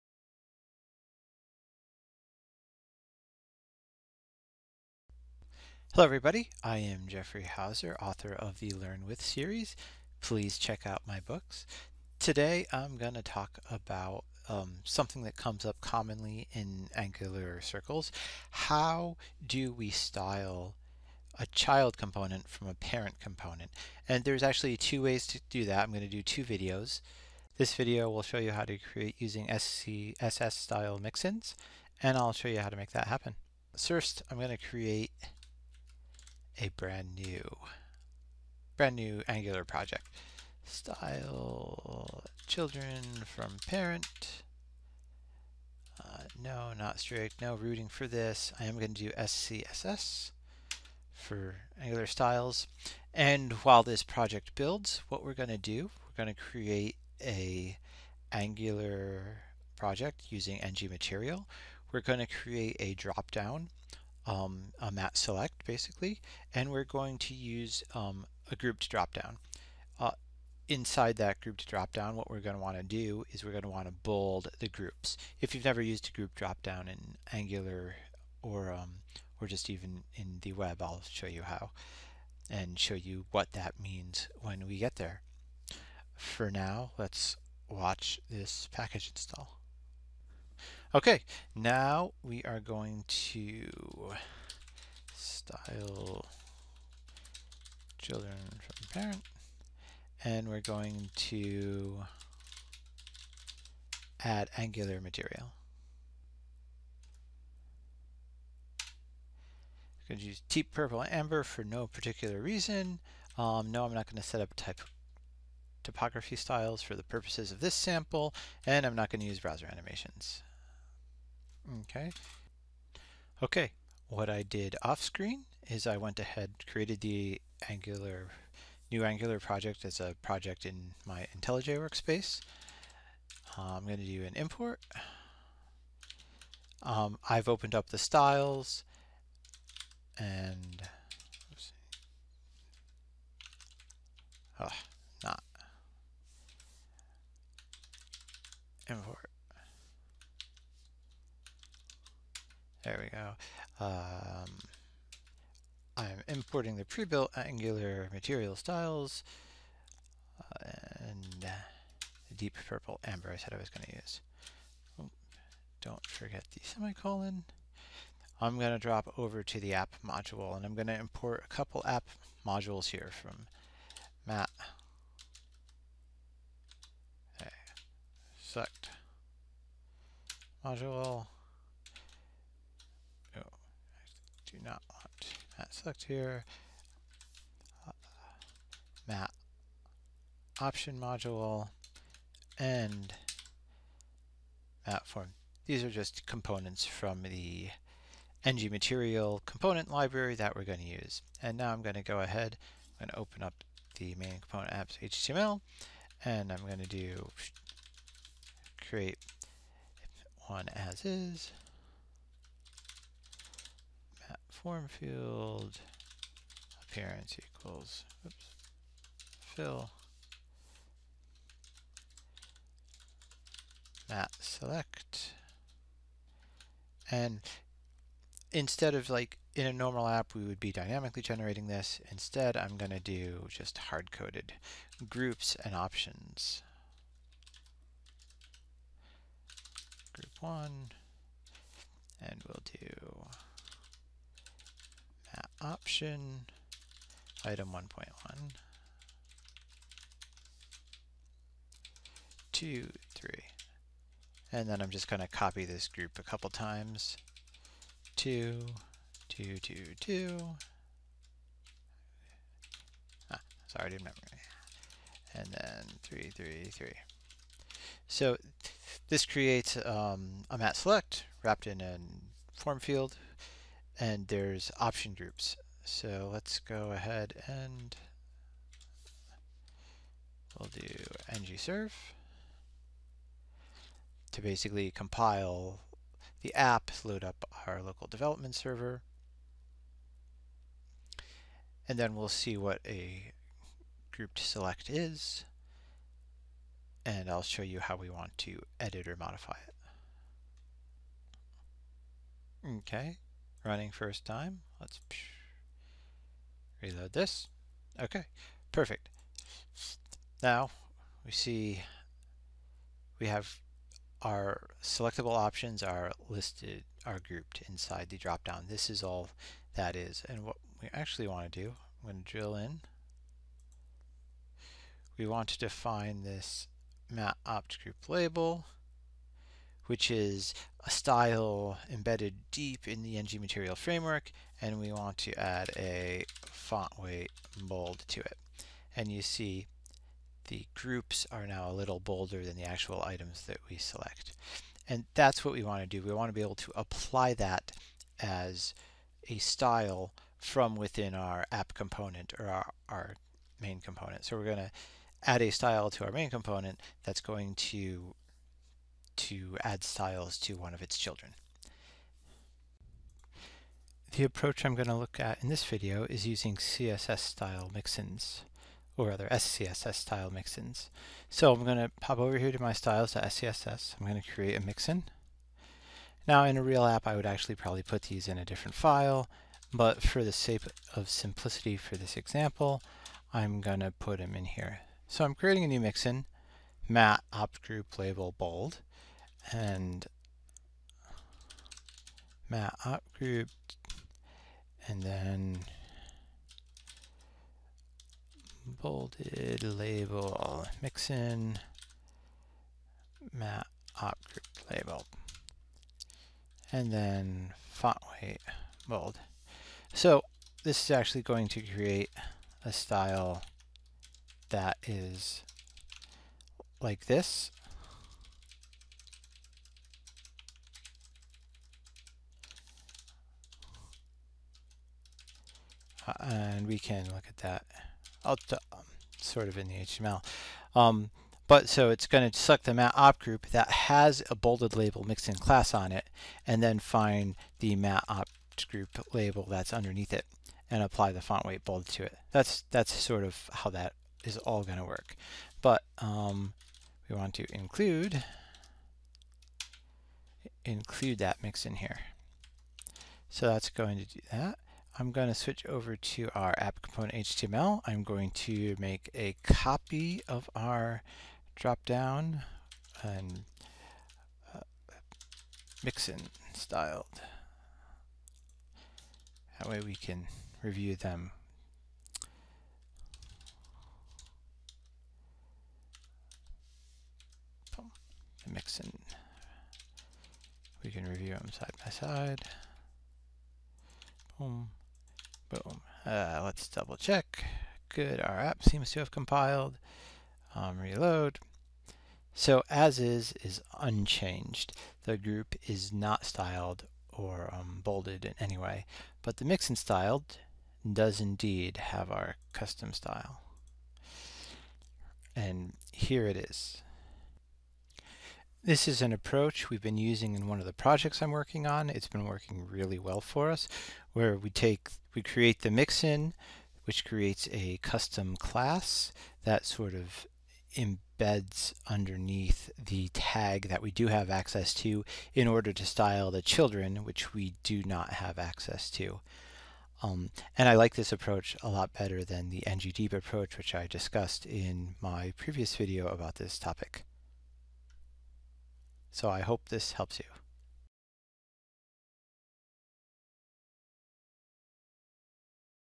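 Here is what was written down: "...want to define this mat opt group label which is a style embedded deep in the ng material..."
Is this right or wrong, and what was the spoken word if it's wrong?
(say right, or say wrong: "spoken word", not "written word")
right.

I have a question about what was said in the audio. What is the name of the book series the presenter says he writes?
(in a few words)
Learn With.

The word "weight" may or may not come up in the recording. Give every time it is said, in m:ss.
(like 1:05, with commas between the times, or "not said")
5:36, 6:48, 7:21.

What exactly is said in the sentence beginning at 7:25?
But um, we want to include include that mix in here.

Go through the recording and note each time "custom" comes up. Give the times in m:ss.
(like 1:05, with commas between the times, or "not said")
8:22, 8:37.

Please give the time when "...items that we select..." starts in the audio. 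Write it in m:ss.
5:43.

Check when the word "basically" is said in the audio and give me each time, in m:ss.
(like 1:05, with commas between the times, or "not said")
1:05, 4:44.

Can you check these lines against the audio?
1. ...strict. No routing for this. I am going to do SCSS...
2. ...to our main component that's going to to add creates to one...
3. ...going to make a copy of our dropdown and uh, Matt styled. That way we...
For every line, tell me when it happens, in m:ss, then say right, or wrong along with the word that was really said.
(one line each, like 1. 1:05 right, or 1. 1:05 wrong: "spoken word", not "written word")
1. 0:46 right
2. 5:55 wrong: "styles", not "creates"
3. 7:38 wrong: "Mixin", not "Matt".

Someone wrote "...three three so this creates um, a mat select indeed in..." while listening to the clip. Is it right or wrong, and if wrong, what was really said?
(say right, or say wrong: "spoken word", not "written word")
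wrong: "wrapped", not "indeed".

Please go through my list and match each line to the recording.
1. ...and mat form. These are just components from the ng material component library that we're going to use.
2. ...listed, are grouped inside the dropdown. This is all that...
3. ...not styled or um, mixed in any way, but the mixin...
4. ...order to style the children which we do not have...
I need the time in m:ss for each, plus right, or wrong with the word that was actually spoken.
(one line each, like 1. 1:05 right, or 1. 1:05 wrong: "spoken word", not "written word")
1. 3:12 right
2. 5:16 right
3. 8:15 wrong: "bolded", not "mixed"
4. 8:45 right.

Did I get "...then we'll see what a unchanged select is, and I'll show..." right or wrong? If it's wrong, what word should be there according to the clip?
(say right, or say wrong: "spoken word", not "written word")
wrong: "grouped", not "unchanged".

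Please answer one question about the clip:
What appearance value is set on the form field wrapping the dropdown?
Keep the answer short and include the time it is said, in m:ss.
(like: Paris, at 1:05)
fill, at 3:39.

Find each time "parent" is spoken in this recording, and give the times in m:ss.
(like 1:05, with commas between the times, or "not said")
0:22, 0:43, 1:39.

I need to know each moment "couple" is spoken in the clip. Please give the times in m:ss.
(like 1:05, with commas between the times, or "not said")
2:51, 4:16.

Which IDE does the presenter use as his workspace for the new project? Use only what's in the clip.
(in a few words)
IntelliJ.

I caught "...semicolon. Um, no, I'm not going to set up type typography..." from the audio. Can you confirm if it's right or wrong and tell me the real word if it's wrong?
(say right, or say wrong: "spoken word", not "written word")
wrong: "reason", not "semicolon".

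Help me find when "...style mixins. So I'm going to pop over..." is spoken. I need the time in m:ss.
6:09.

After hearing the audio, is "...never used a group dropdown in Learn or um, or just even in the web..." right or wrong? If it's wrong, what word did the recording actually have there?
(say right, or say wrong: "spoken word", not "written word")
wrong: "Angular", not "Learn".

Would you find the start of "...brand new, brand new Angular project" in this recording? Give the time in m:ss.
0:36.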